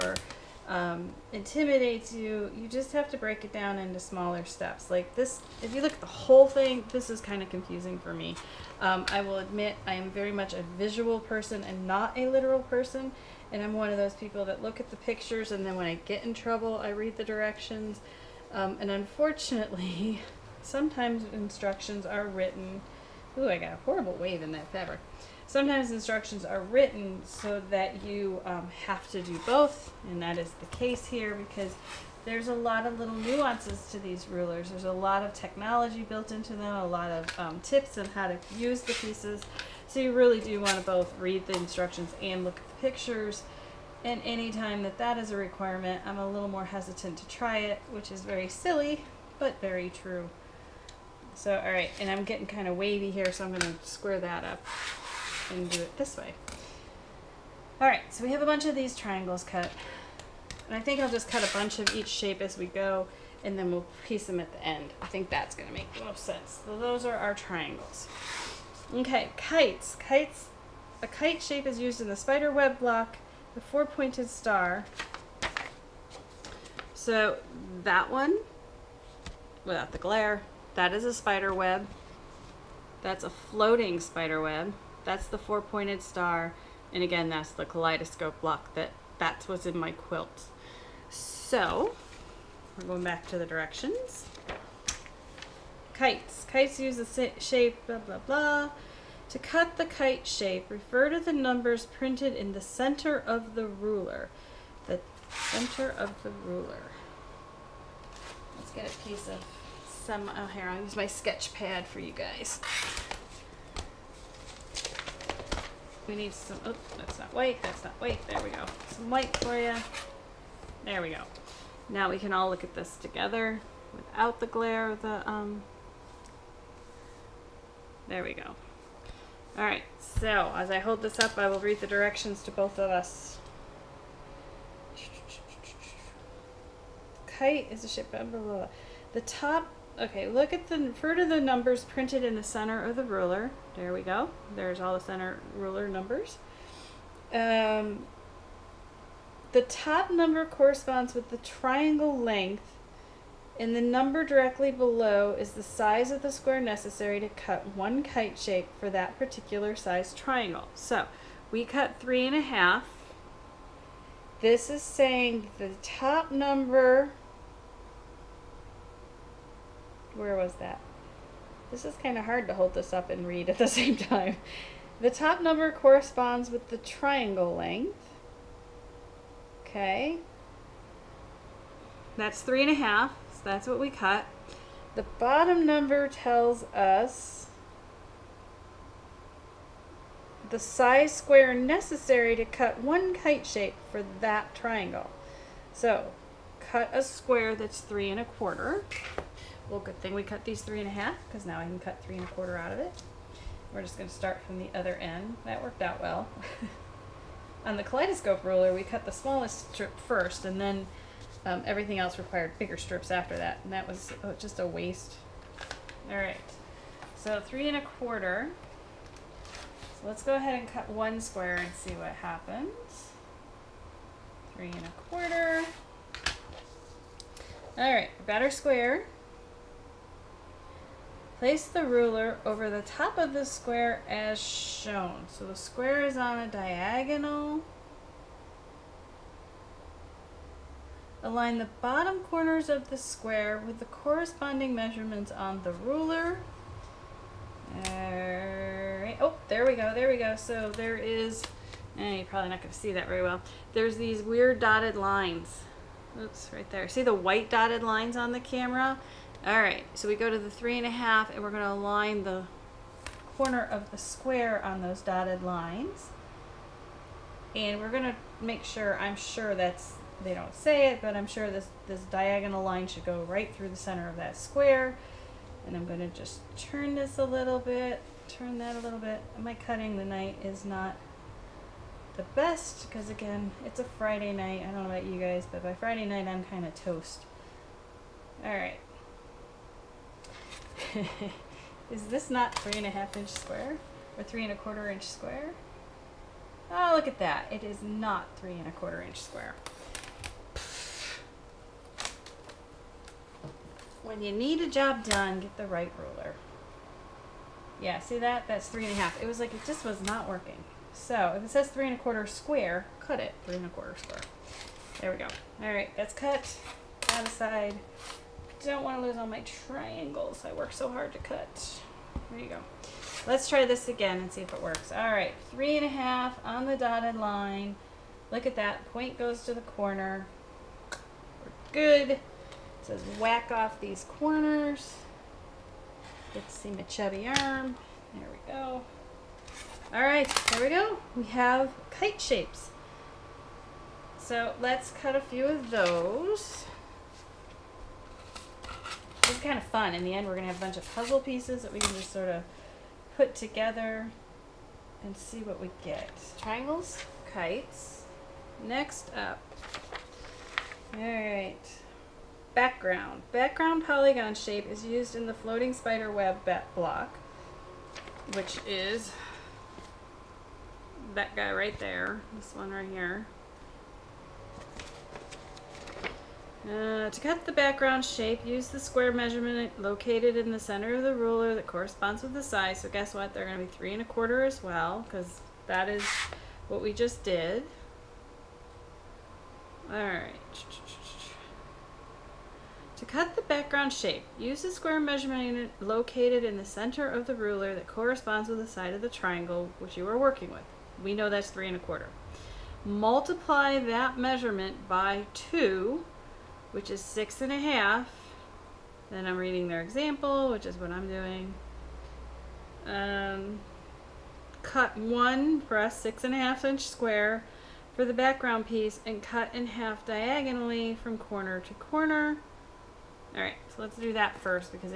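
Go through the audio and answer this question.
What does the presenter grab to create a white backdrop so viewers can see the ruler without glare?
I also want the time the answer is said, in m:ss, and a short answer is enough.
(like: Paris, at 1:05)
sketch pad, at 1:51.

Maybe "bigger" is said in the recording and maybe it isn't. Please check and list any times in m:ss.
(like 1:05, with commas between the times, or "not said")
3:32.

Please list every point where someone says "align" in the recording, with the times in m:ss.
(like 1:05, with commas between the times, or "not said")
4:01, 4:21.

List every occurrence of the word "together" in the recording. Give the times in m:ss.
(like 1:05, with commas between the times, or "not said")
2:02, 5:53.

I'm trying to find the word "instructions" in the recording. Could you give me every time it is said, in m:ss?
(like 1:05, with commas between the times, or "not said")
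0:21, 0:25, 0:41.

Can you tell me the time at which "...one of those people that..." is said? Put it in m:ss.
0:13.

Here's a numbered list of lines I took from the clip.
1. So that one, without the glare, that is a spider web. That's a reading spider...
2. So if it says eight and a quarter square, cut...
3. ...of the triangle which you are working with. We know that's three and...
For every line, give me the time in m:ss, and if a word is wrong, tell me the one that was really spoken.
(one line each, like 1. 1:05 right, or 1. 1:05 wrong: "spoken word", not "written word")
1. 1:16 wrong: "floating", not "reading"
2. 5:10 wrong: "three", not "eight"
3. 6:38 right.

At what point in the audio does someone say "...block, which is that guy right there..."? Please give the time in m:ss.
6:06.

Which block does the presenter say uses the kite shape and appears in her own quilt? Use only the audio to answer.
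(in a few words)
kaleidoscope block.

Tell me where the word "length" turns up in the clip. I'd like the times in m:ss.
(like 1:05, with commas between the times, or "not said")
2:32, 2:57.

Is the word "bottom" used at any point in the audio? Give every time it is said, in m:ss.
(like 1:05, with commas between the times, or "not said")
3:05, 4:01.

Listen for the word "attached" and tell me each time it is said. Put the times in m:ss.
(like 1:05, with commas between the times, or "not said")
not said.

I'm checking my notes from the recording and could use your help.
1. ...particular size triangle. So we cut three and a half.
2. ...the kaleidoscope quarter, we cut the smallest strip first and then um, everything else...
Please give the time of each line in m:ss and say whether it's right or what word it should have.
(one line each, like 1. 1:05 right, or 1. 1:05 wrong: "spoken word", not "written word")
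1. 2:39 right
2. 3:27 wrong: "ruler", not "quarter".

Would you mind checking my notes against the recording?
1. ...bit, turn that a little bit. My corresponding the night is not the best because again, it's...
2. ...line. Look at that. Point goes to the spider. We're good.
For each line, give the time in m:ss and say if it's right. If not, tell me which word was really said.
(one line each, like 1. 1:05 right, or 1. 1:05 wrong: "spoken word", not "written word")
1. 4:37 wrong: "cutting", not "corresponding"
2. 5:27 wrong: "corner", not "spider".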